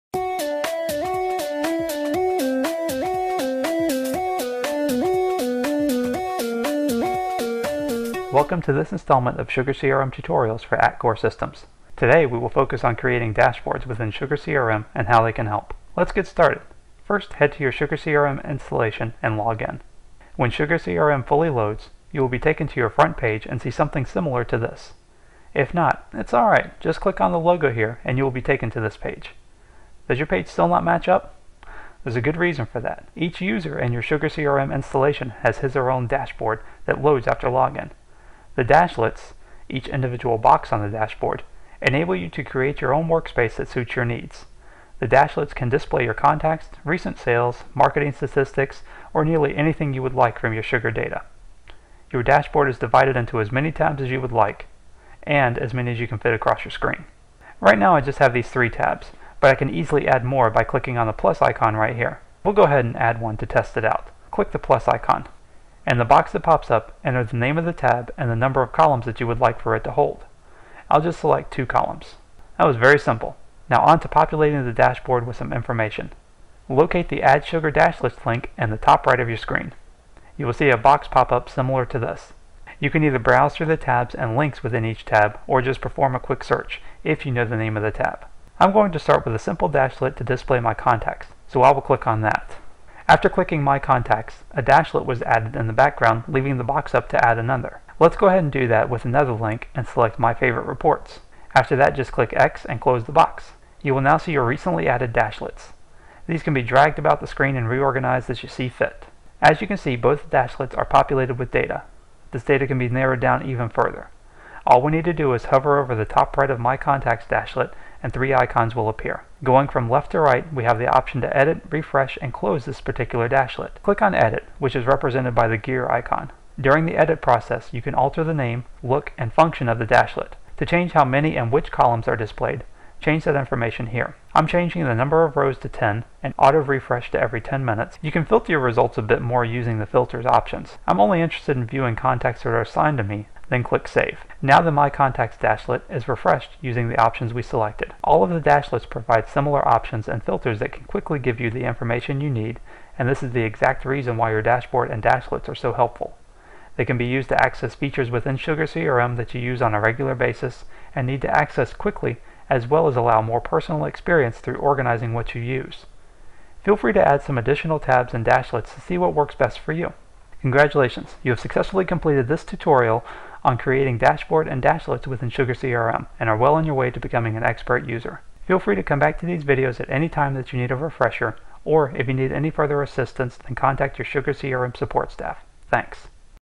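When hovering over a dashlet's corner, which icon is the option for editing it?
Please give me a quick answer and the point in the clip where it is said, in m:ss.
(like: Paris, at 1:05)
gear icon, at 2:05.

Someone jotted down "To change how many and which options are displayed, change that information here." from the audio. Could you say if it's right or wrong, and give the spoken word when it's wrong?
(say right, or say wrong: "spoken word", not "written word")
wrong: "columns", not "options".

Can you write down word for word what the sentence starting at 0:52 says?
Your dashboard is divided into as many tabs as you would like, and as many as you can fit across your screen.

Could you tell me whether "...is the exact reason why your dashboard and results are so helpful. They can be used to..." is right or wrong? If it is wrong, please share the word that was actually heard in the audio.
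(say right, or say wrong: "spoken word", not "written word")
wrong: "dashlets", not "results".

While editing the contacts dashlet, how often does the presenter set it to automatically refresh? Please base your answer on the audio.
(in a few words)
every 10 minutes.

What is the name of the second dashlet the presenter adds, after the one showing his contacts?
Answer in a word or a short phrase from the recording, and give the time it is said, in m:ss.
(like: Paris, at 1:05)
My Favorite Reports, at 1:40.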